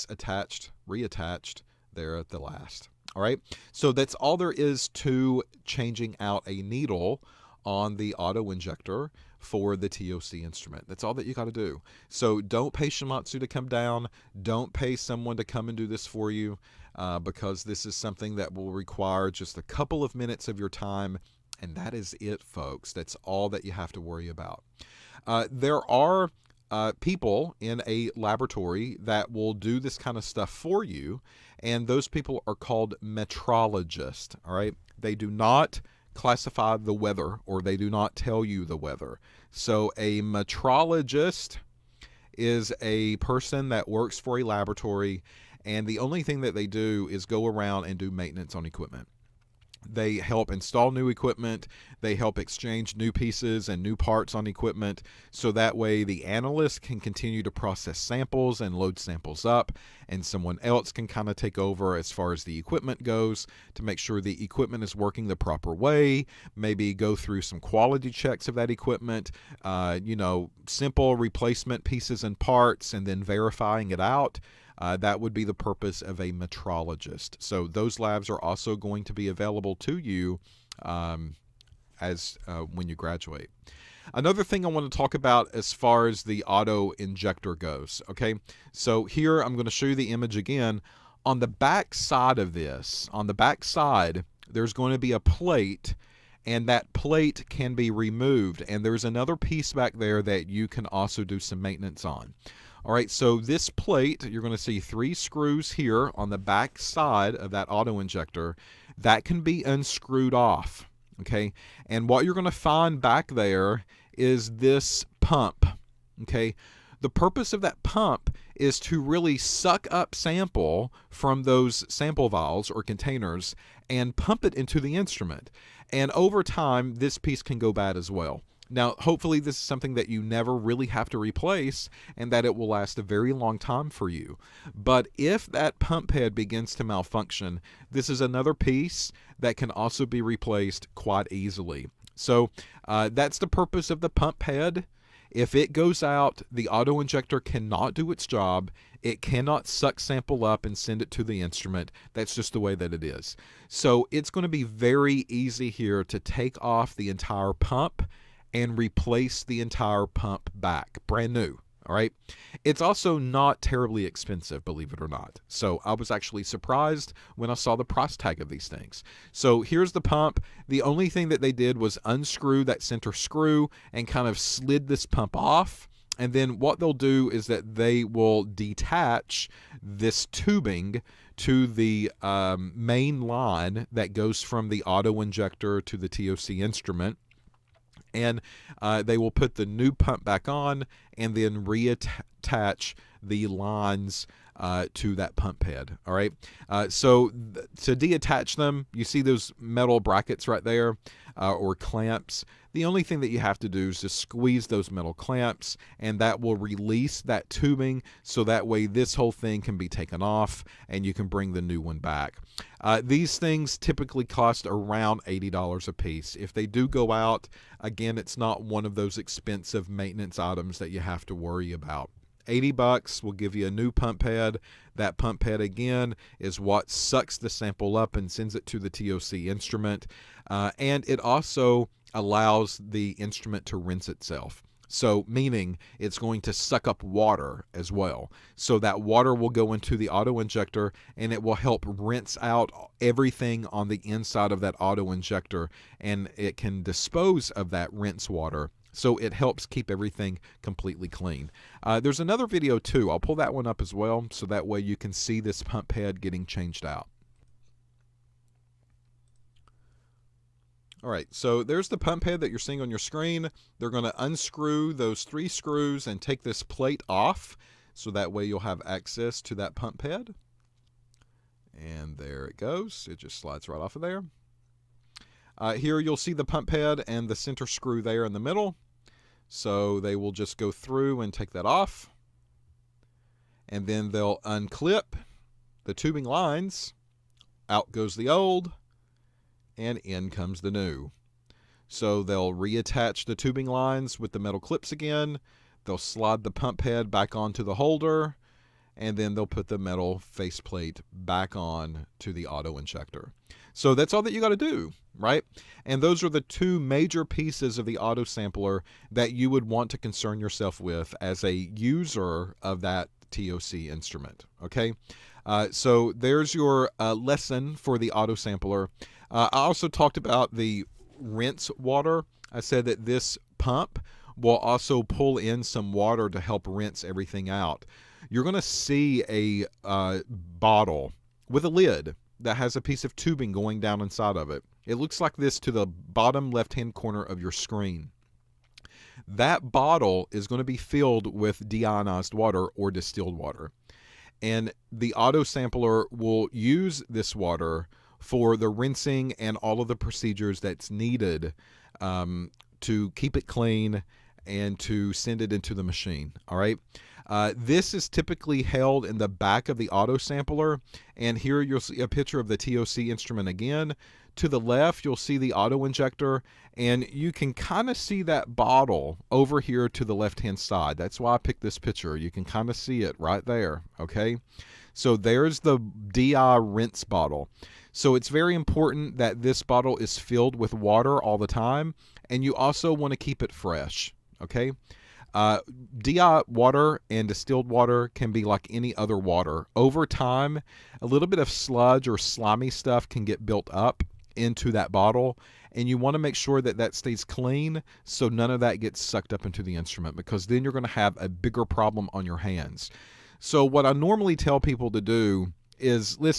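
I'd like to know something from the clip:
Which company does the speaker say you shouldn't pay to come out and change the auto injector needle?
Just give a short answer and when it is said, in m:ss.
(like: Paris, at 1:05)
Shimadzu, at 0:12.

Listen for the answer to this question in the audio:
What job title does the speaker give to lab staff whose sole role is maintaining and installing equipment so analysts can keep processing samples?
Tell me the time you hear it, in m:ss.
0:33.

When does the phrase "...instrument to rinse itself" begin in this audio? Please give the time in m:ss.
3:53.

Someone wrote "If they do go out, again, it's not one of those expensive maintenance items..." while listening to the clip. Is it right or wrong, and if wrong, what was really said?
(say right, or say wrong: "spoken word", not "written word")
right.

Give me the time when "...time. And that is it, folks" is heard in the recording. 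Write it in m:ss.
0:20.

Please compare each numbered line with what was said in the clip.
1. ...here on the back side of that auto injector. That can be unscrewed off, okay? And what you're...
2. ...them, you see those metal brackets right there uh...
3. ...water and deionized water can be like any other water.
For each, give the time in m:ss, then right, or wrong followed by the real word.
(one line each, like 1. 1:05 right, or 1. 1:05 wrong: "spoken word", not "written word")
1. 1:45 right
2. 3:18 right
3. 6:26 wrong: "distilled", not "deionized".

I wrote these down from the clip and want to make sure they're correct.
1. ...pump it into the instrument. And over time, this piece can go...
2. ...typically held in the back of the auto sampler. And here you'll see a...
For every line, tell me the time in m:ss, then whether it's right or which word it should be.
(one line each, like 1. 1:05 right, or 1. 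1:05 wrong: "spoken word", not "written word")
1. 2:04 right
2. 5:58 right.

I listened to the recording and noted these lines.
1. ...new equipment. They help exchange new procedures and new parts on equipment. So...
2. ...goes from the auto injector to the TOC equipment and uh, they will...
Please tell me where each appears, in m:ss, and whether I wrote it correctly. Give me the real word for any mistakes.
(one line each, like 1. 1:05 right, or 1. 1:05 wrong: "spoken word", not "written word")
1. 0:50 wrong: "pieces", not "procedures"
2. 3:04 wrong: "instrument", not "equipment".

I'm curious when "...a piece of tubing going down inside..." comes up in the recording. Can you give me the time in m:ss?
5:32.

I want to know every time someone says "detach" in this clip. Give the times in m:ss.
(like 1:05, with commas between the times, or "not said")
2:58.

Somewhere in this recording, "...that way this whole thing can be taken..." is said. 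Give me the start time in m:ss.
3:28.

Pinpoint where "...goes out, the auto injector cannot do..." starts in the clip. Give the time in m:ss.
2:25.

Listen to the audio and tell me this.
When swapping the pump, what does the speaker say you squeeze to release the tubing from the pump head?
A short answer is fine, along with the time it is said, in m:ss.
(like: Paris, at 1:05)
metal clamps, at 3:24.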